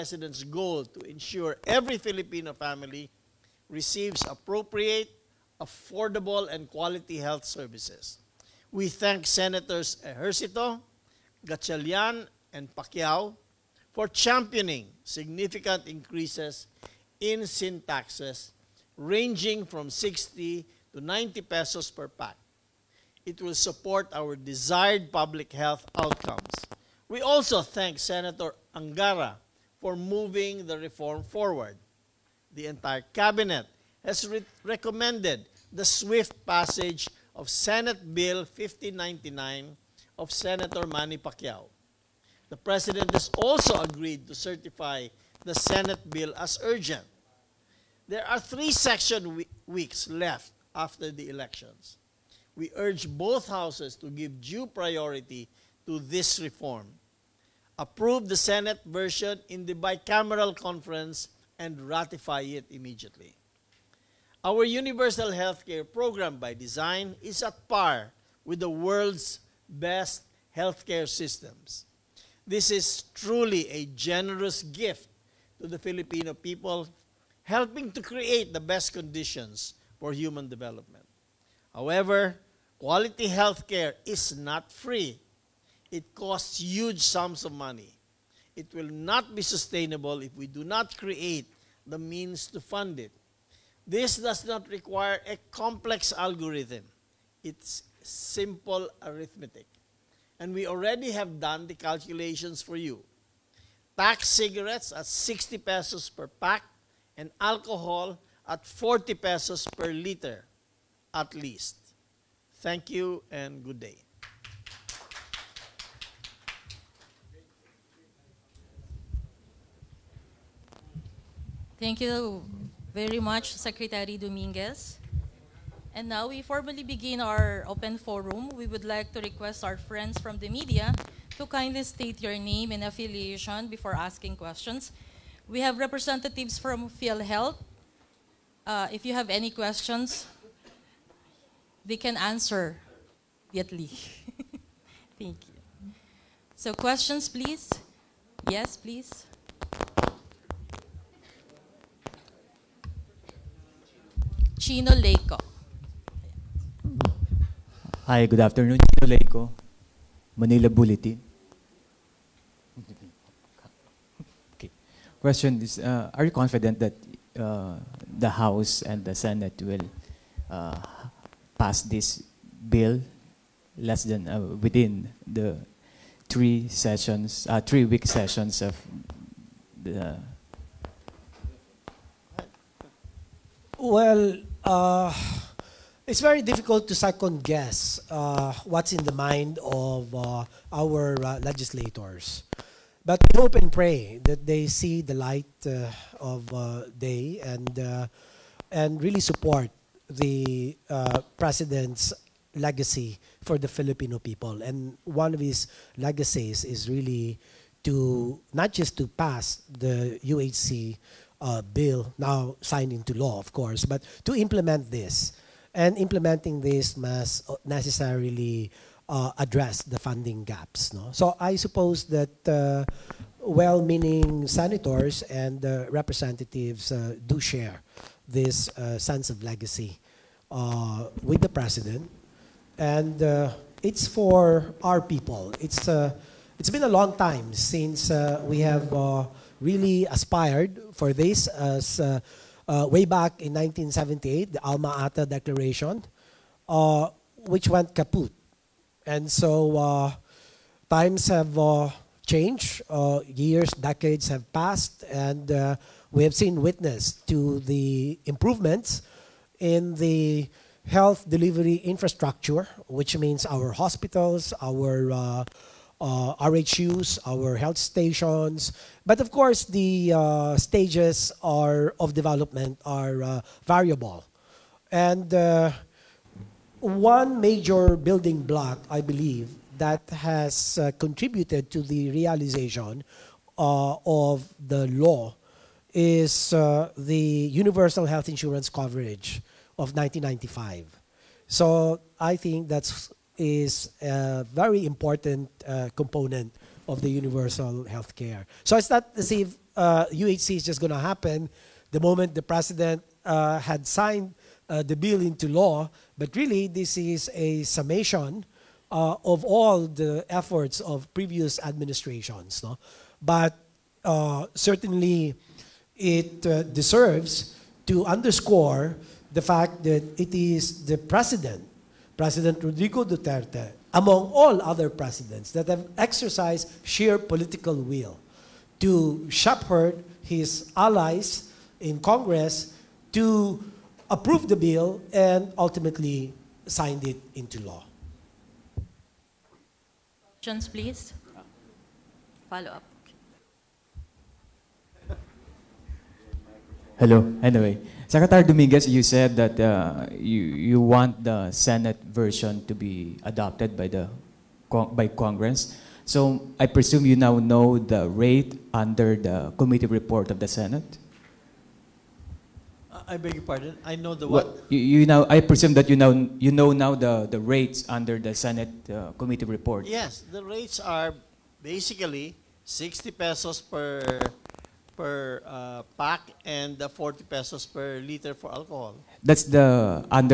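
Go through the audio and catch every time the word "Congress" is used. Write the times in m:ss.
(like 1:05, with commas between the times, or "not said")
5:31, 5:55.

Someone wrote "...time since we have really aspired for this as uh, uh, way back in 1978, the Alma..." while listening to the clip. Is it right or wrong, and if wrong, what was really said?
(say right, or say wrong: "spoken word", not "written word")
right.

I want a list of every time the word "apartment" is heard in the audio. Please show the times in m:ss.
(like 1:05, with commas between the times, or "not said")
not said.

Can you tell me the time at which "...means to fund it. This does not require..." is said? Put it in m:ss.
1:31.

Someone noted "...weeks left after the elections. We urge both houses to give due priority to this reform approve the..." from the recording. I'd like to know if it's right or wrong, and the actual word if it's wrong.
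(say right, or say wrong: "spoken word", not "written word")
right.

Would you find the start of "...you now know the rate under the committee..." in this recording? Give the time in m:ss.
5:57.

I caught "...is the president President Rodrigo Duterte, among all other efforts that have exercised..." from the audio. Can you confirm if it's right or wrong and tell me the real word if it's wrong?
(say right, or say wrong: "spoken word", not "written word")
wrong: "presidents", not "efforts".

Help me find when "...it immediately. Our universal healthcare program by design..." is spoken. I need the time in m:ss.
1:02.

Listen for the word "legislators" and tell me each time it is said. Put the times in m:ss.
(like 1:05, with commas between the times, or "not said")
3:11.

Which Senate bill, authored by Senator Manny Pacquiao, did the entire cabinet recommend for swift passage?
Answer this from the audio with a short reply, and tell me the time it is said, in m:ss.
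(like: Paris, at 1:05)
Senate Bill 1599, at 0:37.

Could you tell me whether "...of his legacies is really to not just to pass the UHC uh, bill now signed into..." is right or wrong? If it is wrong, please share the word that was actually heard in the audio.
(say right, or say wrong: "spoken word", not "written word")
right.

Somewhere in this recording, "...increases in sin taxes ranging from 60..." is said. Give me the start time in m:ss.
0:15.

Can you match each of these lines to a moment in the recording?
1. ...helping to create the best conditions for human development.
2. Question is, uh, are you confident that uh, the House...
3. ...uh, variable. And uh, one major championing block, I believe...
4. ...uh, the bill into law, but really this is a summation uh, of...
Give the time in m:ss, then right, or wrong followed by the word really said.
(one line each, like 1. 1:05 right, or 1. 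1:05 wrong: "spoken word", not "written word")
1. 1:17 right
2. 2:45 right
3. 4:33 wrong: "building", not "championing"
4. 5:04 right.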